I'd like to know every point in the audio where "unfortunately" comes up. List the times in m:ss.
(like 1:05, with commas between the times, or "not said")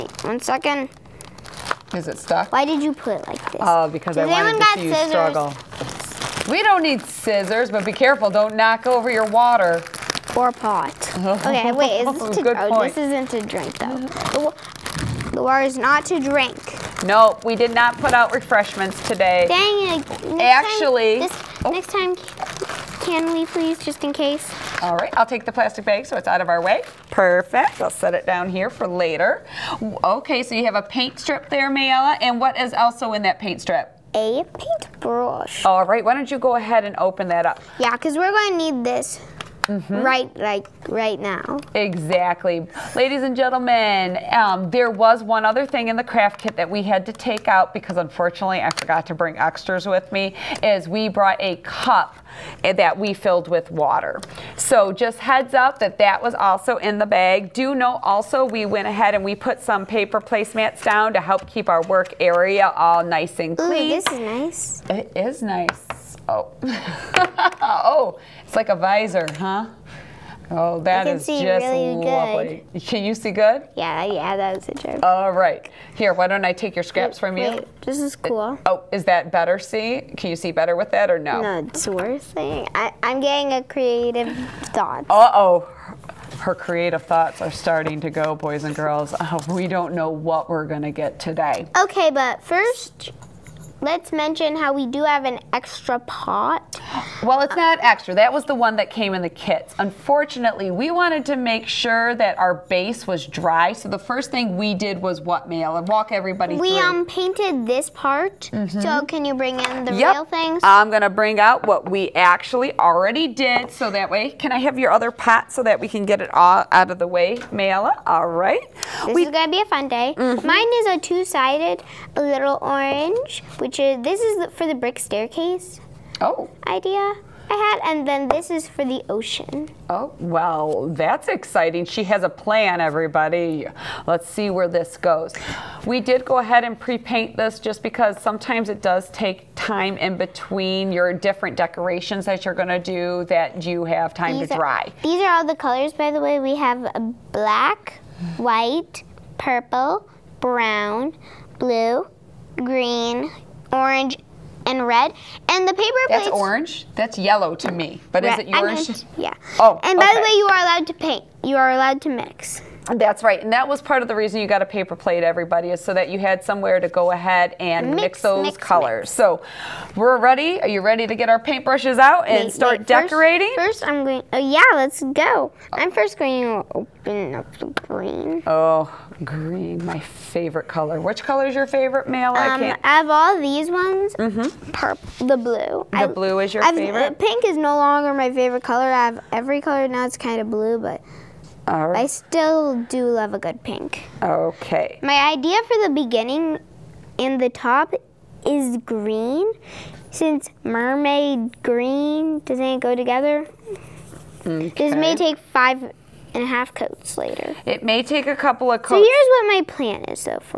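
0:47, 1:39.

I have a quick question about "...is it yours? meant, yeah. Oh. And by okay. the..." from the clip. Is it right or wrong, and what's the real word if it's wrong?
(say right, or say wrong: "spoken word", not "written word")
right.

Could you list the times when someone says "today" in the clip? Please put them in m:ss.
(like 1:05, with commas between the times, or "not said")
0:19, 1:31.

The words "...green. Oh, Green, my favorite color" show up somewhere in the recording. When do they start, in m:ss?
2:57.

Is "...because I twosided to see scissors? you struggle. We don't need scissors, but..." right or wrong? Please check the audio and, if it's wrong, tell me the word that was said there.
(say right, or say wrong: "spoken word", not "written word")
wrong: "wanted", not "twosided".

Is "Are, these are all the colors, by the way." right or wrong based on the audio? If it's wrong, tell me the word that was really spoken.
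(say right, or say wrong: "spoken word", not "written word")
right.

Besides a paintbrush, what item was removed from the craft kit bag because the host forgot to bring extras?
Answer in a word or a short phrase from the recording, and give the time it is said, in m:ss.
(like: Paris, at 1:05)
a cup, at 0:51.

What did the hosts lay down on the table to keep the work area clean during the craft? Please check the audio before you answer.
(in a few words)
paper placemats.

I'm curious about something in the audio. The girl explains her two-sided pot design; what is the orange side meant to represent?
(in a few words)
brick staircase.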